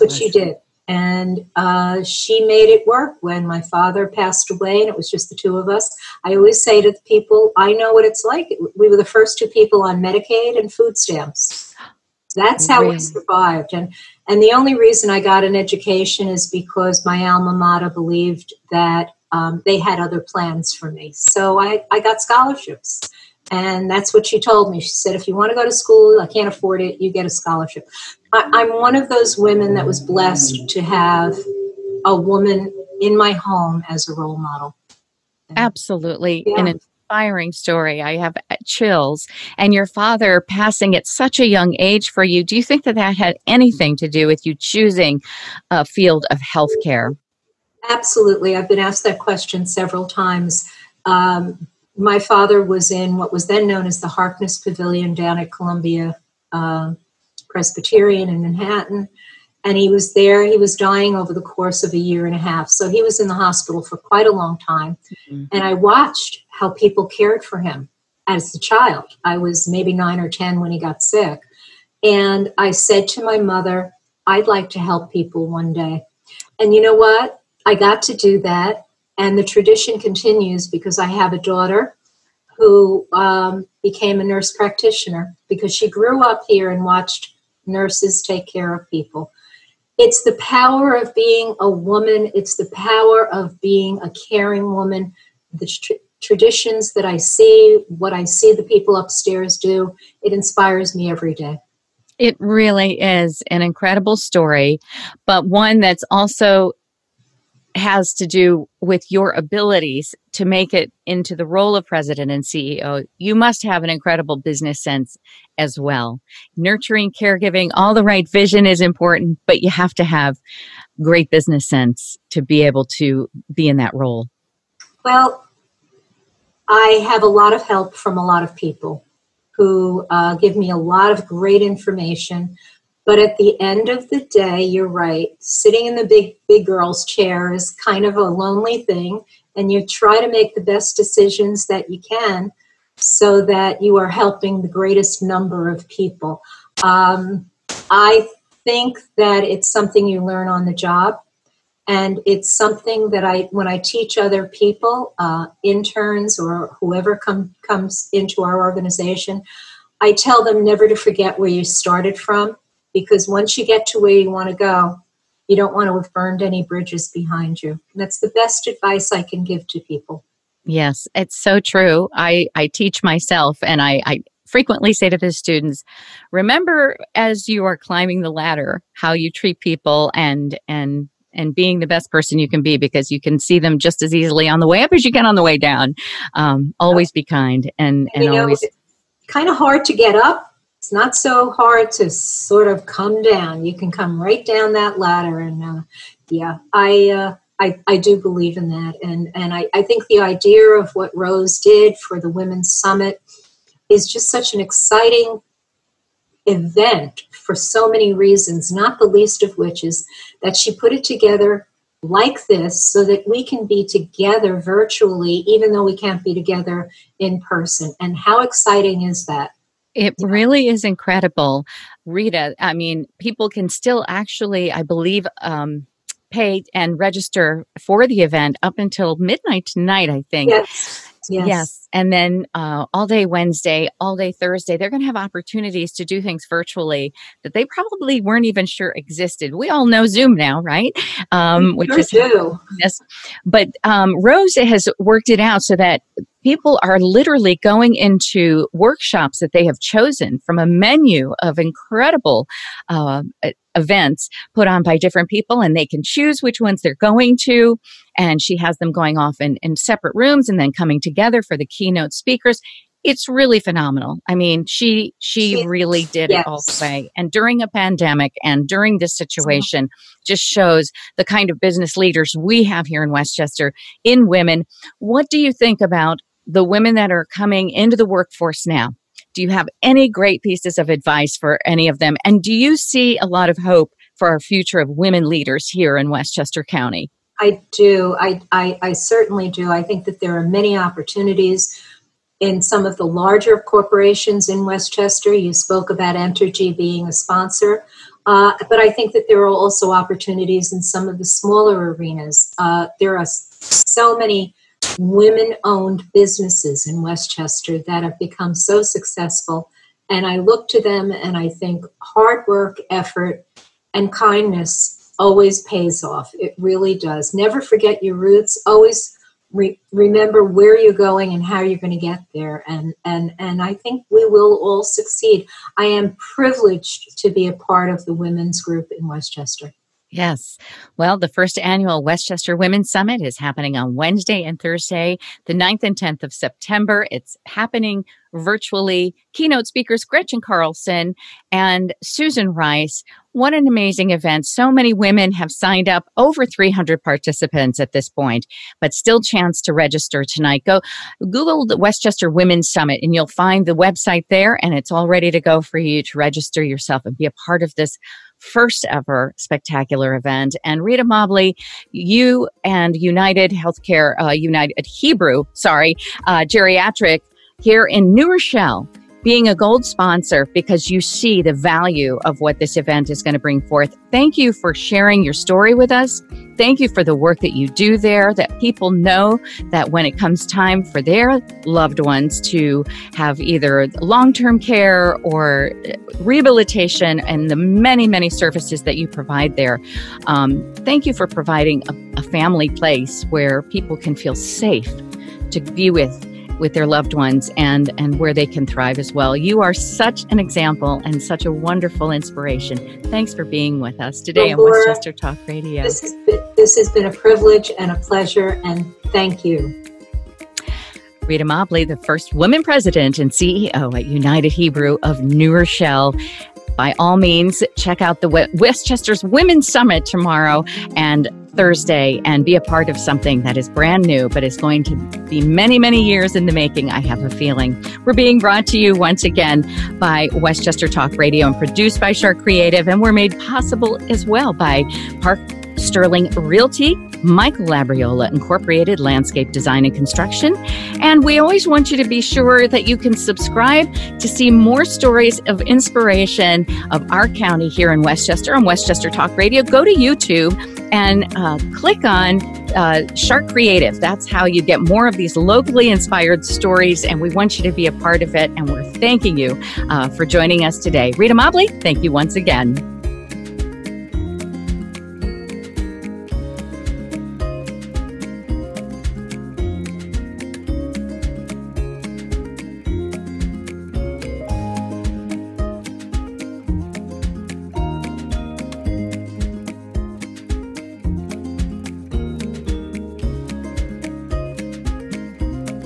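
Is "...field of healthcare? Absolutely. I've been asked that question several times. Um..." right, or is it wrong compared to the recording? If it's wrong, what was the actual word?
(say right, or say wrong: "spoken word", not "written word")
right.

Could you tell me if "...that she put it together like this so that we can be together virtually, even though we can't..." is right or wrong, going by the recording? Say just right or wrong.
right.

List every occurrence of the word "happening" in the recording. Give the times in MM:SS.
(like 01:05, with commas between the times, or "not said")
05:33, 05:37.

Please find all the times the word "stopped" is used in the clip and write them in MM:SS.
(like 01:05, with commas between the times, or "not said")
not said.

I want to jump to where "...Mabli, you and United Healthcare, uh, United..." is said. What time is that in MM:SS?
06:01.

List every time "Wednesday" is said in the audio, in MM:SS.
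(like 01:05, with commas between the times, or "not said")
03:53, 05:33.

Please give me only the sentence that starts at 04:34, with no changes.
What do you think about the women that are coming into the workforce now?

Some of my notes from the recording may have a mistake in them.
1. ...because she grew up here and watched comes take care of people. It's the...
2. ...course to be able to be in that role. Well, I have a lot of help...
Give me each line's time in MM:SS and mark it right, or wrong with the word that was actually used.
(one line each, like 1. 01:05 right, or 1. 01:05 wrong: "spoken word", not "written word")
1. 01:25 wrong: "nurses", not "comes"
2. 02:01 wrong: "sense", not "course".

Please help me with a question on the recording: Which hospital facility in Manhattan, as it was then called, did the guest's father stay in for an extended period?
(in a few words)
Harkness Pavilion.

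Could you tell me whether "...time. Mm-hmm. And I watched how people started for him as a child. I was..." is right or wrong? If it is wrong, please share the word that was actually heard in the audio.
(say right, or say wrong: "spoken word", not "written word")
wrong: "cared", not "started".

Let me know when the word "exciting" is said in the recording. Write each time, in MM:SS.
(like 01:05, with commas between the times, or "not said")
03:24, 03:38.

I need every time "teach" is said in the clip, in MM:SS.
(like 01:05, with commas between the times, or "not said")
02:33, 02:52.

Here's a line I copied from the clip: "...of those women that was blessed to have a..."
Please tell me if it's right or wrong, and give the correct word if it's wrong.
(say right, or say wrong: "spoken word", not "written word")
right.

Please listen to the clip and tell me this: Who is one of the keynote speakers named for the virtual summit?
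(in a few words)
Gretchen Carlson and Susan Rice.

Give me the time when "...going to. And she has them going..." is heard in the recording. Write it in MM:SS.
04:16.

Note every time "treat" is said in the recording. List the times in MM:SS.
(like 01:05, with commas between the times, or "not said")
02:59.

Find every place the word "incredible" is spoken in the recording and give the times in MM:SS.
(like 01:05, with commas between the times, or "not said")
01:43, 01:53, 03:40, 04:11.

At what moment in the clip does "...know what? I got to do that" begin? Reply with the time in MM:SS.
01:16.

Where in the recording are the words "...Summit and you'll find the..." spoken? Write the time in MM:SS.
05:52.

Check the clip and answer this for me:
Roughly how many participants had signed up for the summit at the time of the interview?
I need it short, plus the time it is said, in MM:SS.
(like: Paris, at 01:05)
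over 300, at 05:46.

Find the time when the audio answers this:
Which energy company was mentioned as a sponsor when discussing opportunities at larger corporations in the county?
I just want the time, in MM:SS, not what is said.
04:56.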